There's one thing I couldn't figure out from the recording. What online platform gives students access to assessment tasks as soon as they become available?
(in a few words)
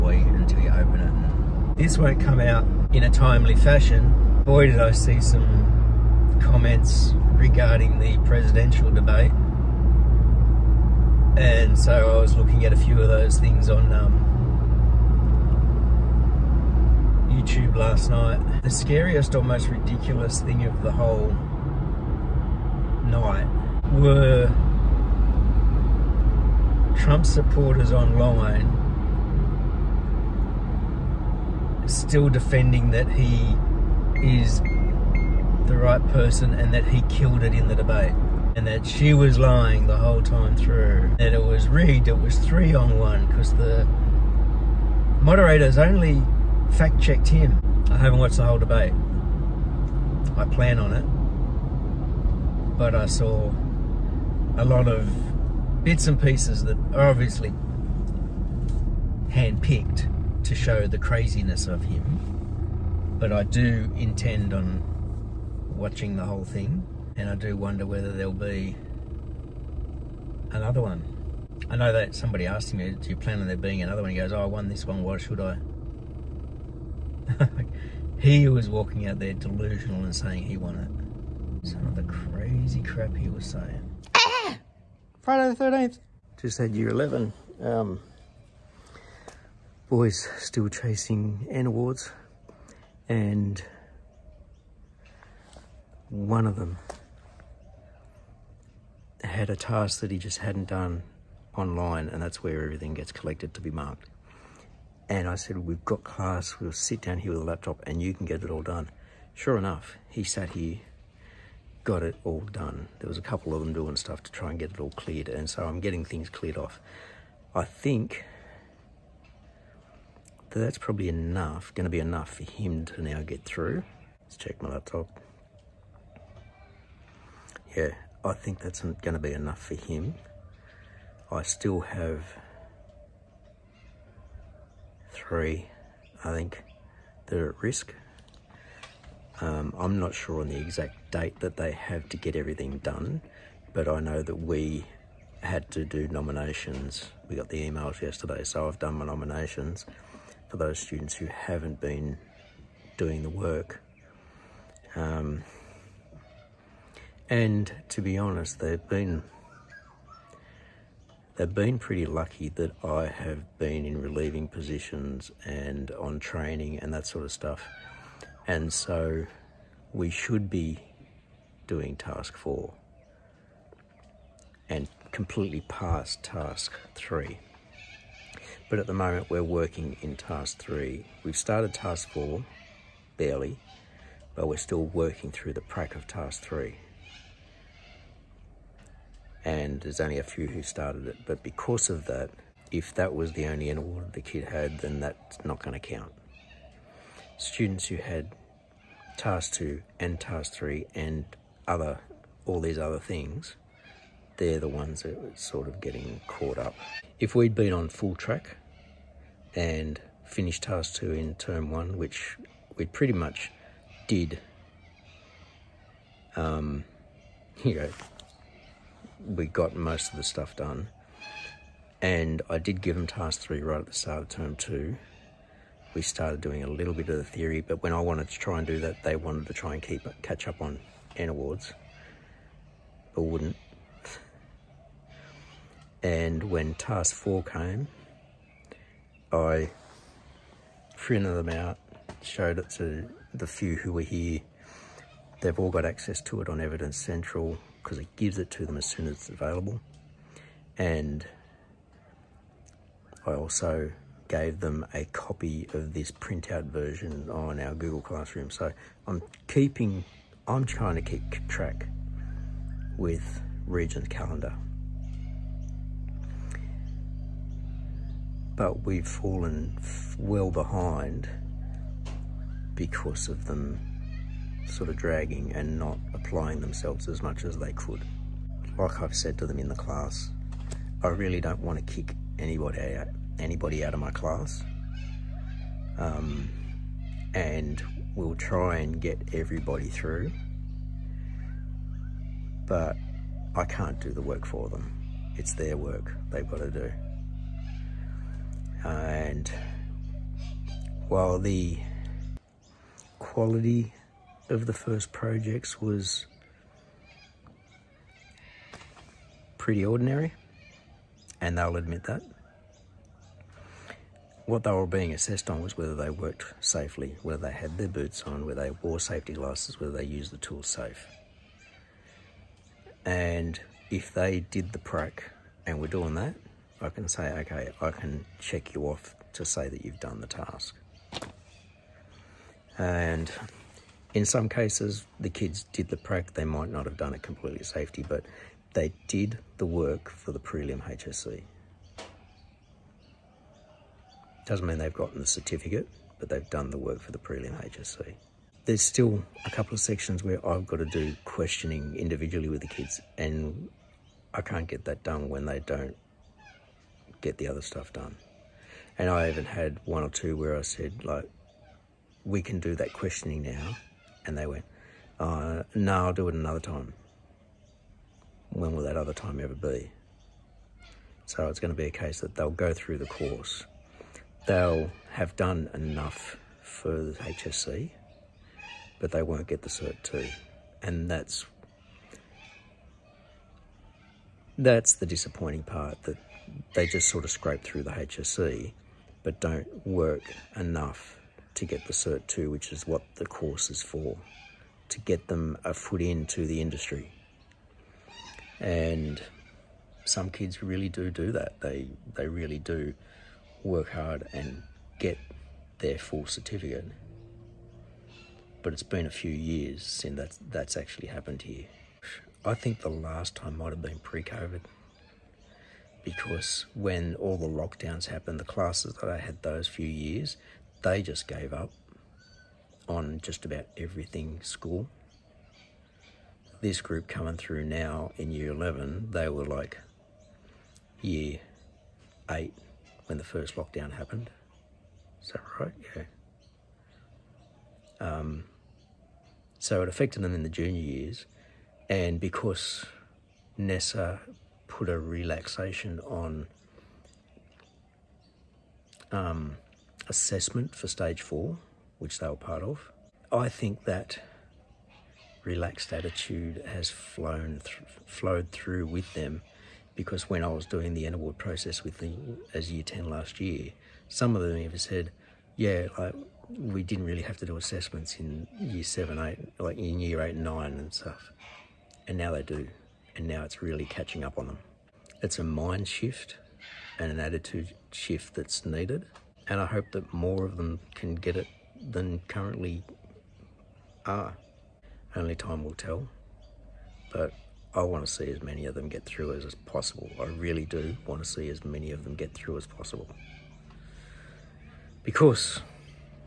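Evidence Central.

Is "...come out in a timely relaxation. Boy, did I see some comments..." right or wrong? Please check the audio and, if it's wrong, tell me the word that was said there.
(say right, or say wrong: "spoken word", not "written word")
wrong: "fashion", not "relaxation".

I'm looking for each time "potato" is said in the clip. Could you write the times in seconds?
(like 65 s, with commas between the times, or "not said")
not said.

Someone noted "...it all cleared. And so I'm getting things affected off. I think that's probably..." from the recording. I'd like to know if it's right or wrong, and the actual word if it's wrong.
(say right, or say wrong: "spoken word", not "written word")
wrong: "cleared", not "affected".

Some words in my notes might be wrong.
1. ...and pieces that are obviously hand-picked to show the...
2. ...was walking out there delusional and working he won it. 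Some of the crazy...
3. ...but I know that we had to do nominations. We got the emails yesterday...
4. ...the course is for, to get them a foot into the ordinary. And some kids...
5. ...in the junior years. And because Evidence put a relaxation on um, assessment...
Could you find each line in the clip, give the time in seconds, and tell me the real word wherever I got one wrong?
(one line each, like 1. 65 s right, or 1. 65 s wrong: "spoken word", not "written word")
1. 56 s right
2. 78 s wrong: "saying", not "working"
3. 143 s right
4. 393 s wrong: "industry", not "ordinary"
5. 440 s wrong: "NESA", not "Evidence".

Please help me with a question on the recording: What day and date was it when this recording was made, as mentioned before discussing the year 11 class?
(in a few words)
Friday the 13th.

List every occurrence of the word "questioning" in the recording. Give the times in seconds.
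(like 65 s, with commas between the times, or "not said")
351 s, 362 s.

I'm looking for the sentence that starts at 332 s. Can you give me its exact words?
And in some cases, the kids did the prac.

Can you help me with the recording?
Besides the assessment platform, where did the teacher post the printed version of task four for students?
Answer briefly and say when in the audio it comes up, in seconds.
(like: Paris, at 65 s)
Google Classroom, at 257 s.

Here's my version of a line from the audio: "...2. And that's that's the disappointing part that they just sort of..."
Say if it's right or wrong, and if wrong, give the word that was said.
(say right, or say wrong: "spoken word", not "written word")
right.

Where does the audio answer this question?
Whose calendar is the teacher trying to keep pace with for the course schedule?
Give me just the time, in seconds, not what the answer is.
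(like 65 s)
263 s.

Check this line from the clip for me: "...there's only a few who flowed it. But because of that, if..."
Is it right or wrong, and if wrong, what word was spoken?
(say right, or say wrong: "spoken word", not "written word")
wrong: "started", not "flowed".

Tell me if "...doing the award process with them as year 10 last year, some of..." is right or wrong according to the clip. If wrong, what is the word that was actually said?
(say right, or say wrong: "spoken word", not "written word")
right.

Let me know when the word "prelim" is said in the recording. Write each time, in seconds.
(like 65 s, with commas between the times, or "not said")
340 s, 347 s.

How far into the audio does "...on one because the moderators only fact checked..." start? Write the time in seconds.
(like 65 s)
42 s.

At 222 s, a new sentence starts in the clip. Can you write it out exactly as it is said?
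And I did give them task three right at the start of term two.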